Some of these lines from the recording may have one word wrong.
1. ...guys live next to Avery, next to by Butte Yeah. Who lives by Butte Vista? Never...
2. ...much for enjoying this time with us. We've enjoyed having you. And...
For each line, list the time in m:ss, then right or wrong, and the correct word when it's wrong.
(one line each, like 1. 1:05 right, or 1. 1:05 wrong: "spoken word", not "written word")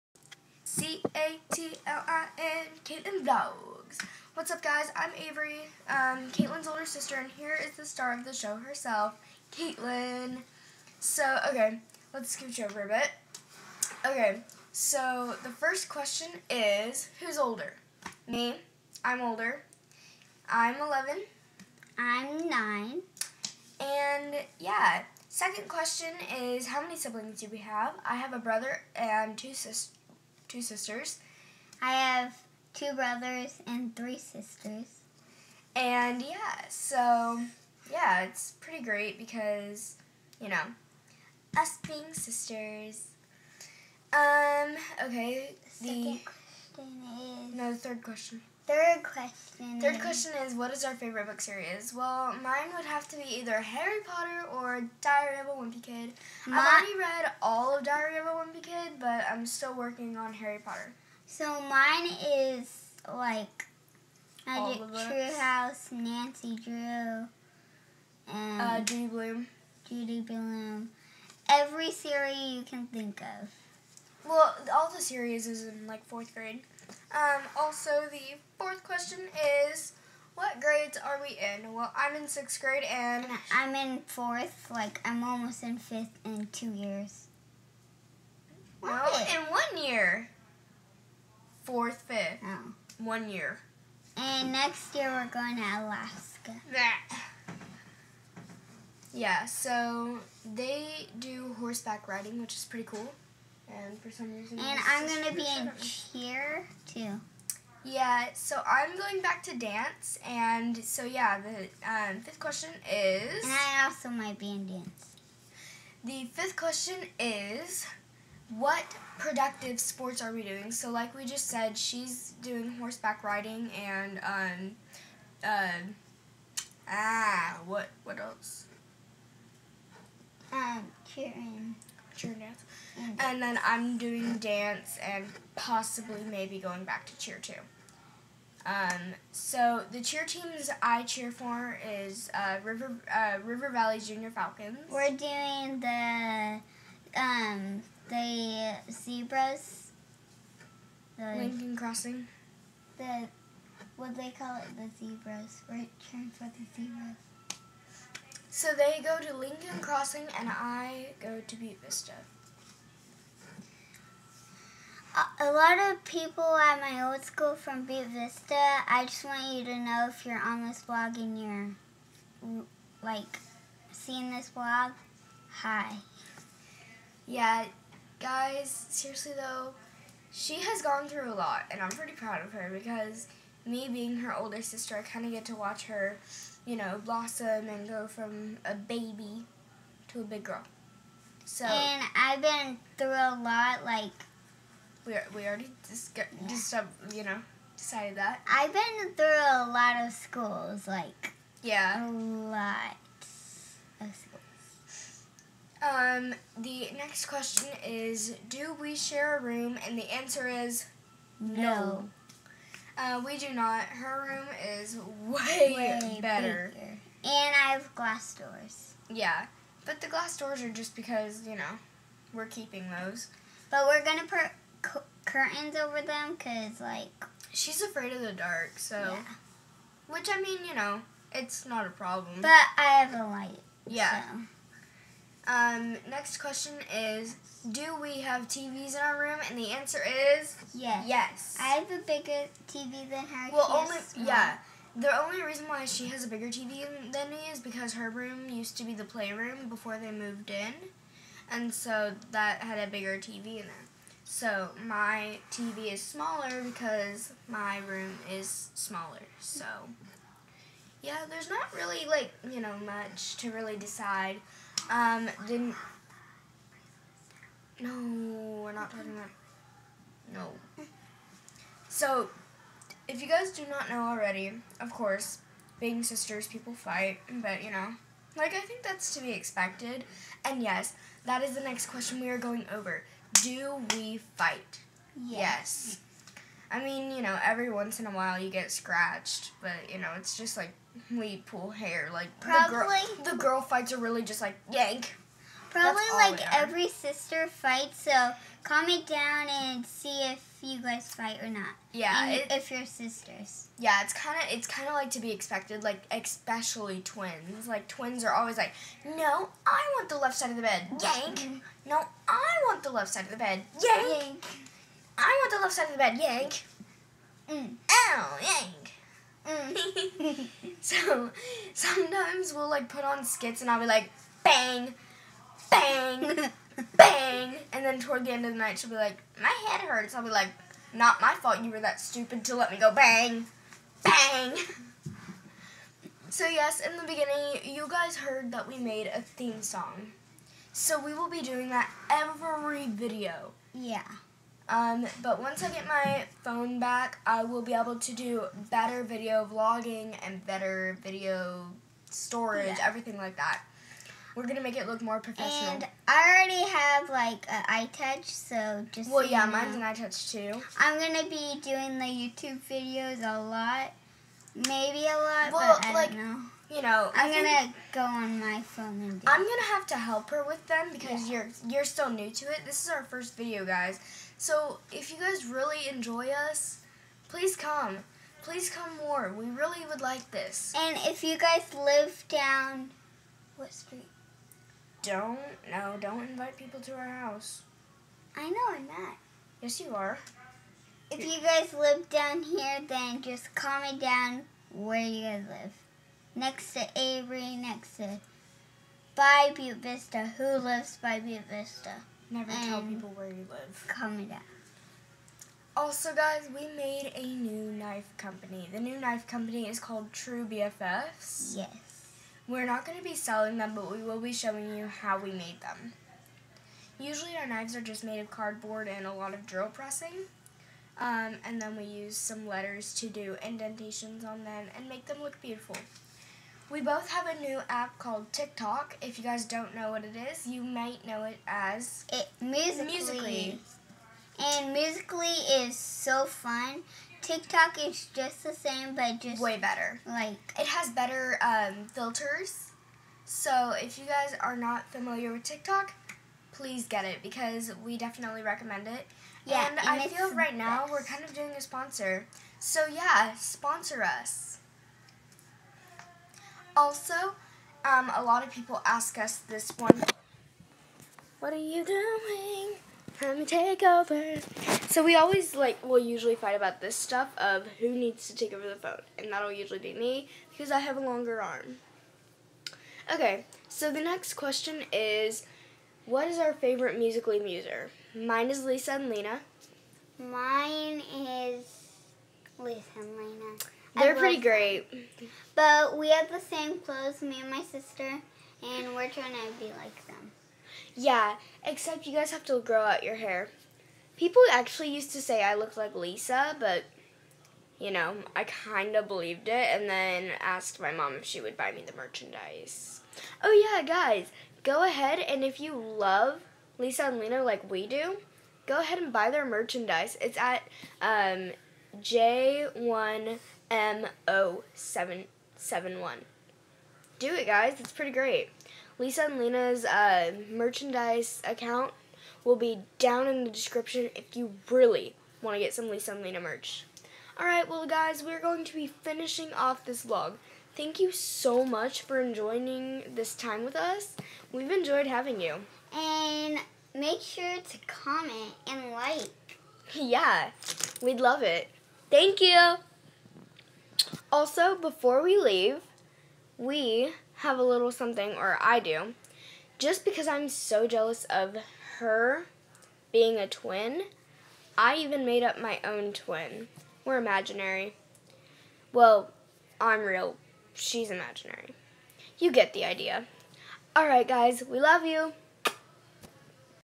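1. 6:35 wrong: "Vista", not "Yeah"
2. 8:51 right.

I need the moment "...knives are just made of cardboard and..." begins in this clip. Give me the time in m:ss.
6:57.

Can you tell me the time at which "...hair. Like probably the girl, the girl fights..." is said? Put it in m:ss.
4:51.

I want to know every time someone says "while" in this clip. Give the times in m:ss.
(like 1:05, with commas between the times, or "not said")
4:48.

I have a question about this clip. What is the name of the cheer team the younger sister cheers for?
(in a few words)
River Valley Junior Falcons.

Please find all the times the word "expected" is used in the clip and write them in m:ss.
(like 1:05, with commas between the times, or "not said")
4:39, 5:05.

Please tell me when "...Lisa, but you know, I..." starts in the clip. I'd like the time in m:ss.
8:15.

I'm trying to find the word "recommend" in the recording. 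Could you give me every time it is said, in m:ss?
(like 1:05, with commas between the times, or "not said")
7:28.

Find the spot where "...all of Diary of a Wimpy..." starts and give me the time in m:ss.
0:57.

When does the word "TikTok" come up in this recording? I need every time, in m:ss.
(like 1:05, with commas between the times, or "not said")
7:08, 7:17, 7:25.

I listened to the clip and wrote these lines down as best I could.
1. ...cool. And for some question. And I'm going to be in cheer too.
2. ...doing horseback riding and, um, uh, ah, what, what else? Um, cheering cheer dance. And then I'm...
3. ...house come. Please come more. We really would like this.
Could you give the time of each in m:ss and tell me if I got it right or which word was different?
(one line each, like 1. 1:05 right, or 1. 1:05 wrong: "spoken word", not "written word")
1. 1:42 wrong: "reason", not "question"
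2. 2:02 right
3. 6:17 wrong: "please", not "house".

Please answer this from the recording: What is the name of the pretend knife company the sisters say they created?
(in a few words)
True BFFs.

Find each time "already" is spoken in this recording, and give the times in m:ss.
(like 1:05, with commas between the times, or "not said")
0:56, 3:15, 4:34, 5:56.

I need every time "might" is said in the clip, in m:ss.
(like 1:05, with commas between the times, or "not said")
1:54, 7:10.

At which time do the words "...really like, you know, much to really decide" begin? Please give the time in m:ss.
4:21.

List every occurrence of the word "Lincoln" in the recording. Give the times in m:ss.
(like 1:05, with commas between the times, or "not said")
2:31, 2:39.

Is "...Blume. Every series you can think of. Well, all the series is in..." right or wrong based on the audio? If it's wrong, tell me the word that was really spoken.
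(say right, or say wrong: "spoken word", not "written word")
right.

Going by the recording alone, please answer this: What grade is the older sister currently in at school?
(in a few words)
Sixth grade.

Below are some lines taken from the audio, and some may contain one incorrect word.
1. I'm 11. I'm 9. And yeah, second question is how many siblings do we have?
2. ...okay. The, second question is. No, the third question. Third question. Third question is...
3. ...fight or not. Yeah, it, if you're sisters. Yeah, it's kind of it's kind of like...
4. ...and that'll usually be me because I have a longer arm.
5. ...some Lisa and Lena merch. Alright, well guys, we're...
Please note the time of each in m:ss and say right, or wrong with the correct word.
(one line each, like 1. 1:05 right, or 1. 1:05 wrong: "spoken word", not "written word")
1. 0:20 right
2. 0:45 right
3. 5:01 right
4. 7:49 right
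5. 8:45 right.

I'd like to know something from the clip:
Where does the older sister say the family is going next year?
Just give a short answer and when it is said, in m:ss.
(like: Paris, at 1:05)
Alaska, at 1:35.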